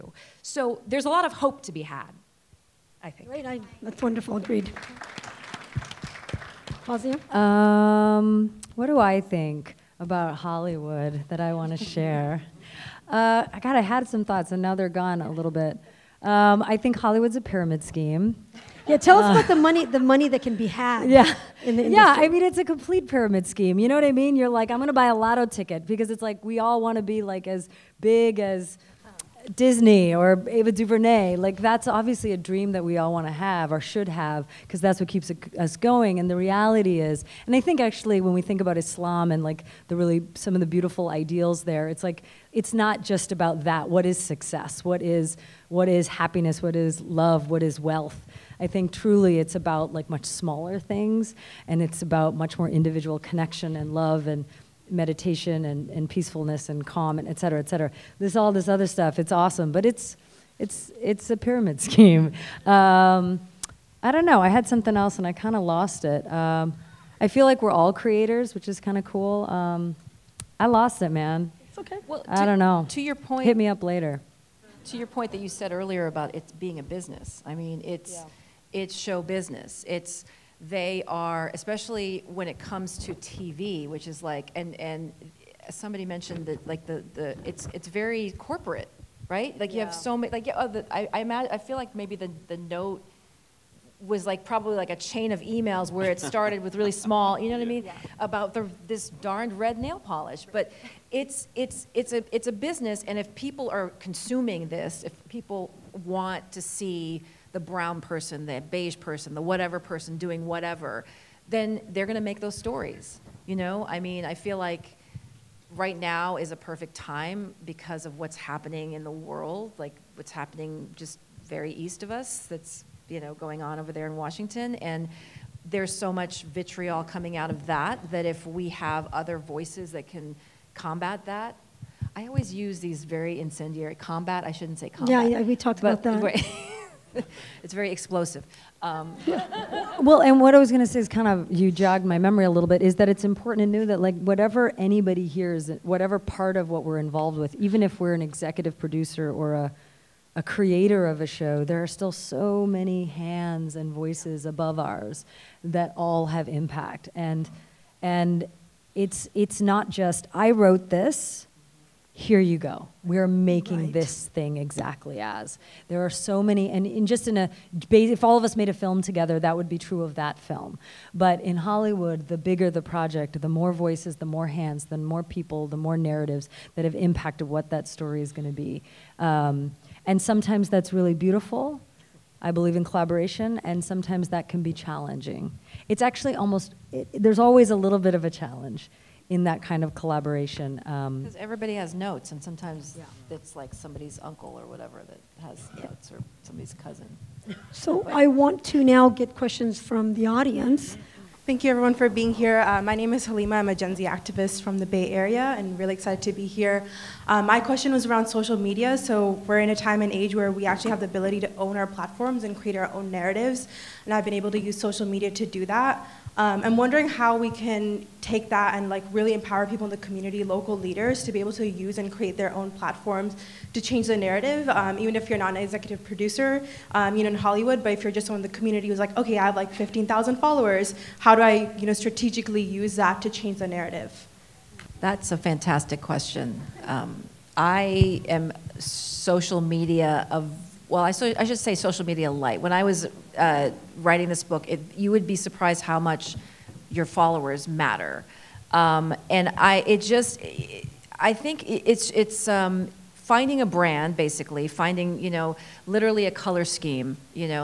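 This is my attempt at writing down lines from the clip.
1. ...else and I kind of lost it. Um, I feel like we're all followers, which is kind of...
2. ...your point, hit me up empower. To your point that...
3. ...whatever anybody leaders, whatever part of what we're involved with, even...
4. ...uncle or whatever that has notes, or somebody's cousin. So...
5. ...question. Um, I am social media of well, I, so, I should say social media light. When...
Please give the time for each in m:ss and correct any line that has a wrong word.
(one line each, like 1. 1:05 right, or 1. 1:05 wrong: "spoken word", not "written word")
1. 1:04 wrong: "creators", not "followers"
2. 1:13 wrong: "later", not "empower"
3. 2:24 wrong: "hears", not "leaders"
4. 3:14 right
5. 3:56 right.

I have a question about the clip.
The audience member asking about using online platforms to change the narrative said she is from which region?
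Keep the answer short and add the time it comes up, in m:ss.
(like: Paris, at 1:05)
the Bay Area, at 3:24.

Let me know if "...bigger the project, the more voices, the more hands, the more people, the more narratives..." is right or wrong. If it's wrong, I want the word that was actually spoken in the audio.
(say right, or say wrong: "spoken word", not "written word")
right.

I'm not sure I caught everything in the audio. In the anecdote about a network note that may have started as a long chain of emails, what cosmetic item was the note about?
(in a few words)
red nail polish.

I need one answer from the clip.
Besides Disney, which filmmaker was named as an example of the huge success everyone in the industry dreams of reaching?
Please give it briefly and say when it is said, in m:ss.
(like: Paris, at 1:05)
Ava DuVernay, at 0:30.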